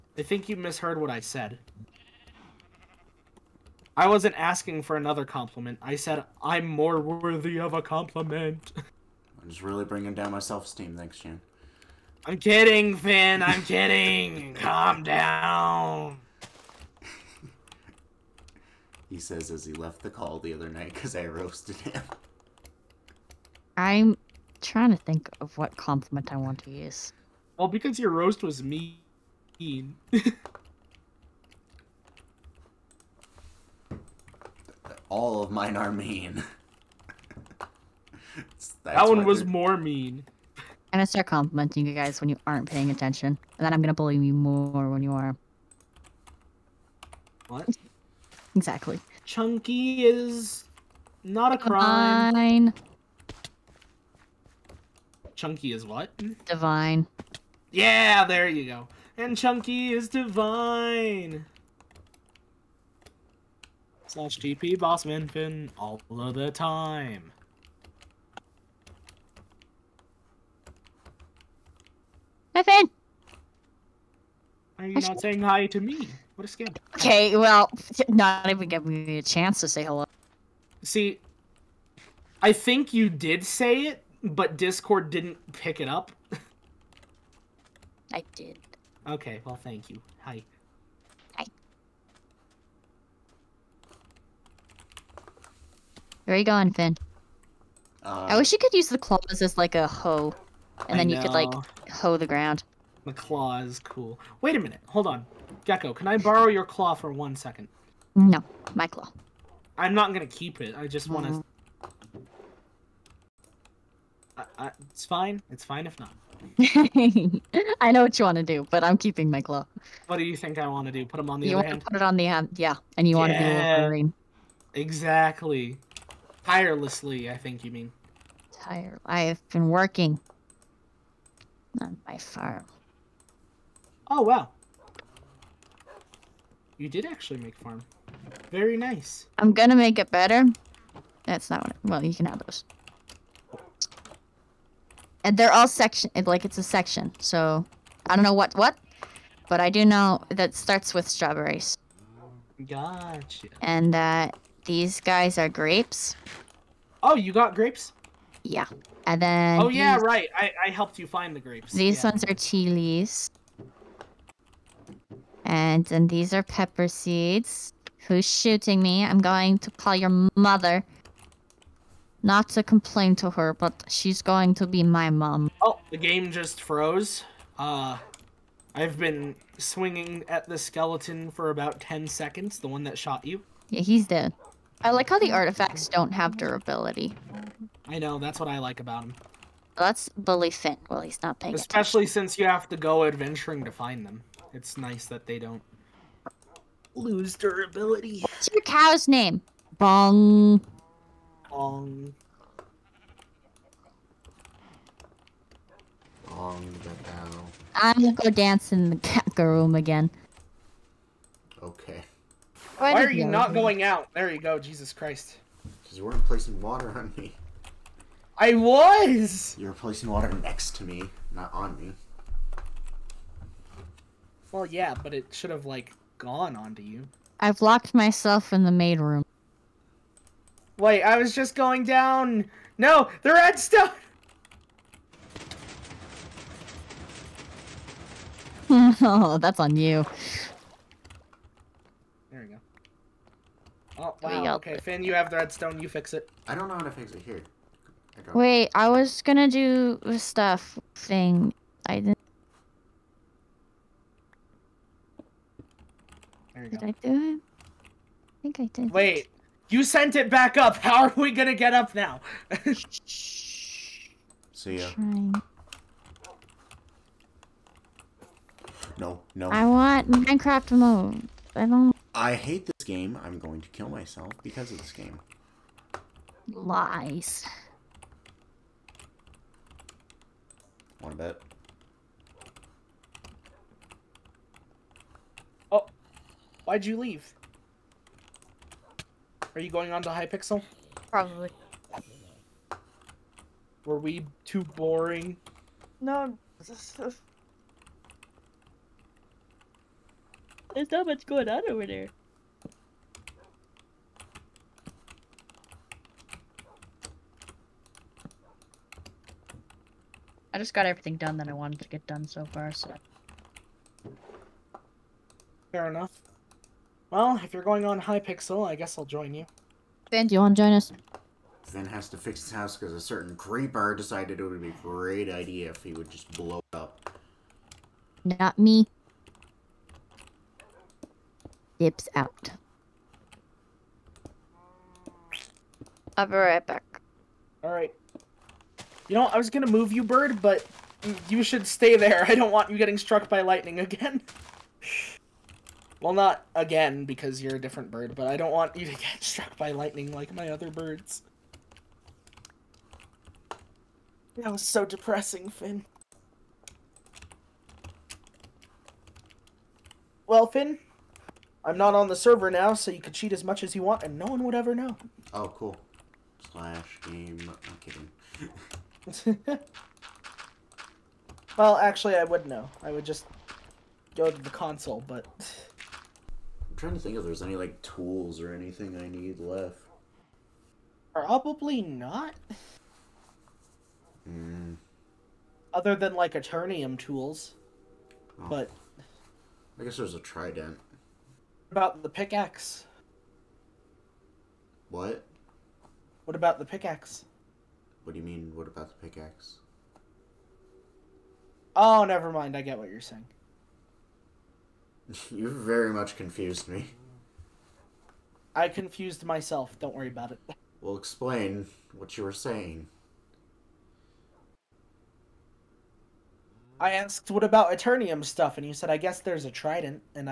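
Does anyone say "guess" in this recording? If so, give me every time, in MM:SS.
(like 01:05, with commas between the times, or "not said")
05:18, 06:29, 06:58.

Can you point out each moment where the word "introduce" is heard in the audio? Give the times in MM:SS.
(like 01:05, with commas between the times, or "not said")
not said.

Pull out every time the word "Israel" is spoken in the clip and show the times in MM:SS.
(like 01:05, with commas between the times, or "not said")
not said.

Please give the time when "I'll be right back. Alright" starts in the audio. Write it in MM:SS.
05:36.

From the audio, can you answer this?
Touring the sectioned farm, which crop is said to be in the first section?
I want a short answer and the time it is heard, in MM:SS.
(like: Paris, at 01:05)
strawberries, at 02:31.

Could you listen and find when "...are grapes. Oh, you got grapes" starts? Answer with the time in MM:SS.
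02:35.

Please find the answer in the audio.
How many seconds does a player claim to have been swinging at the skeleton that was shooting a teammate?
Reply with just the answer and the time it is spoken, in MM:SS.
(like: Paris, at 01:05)
10, at 03:01.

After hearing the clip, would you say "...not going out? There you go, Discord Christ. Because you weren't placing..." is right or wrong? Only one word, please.
wrong.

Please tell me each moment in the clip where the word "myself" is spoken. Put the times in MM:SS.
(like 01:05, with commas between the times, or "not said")
03:47, 04:33, 06:49.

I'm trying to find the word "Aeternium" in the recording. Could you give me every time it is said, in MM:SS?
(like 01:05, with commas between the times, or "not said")
06:26, 06:57.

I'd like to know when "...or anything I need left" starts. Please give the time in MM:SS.
06:18.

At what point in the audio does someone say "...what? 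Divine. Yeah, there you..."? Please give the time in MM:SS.
00:55.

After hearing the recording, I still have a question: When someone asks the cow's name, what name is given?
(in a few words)
Bong the bell.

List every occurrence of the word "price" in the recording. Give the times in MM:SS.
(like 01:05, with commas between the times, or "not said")
not said.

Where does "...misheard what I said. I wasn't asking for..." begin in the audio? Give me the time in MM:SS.
00:00.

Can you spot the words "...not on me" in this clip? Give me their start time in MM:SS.
03:41.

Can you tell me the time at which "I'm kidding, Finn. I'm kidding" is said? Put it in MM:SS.
00:12.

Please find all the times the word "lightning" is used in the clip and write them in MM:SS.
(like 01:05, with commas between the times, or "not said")
05:43, 05:49.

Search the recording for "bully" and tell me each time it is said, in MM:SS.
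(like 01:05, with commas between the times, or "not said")
00:43, 03:10.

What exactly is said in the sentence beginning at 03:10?
Well, he's not paying Especially attention.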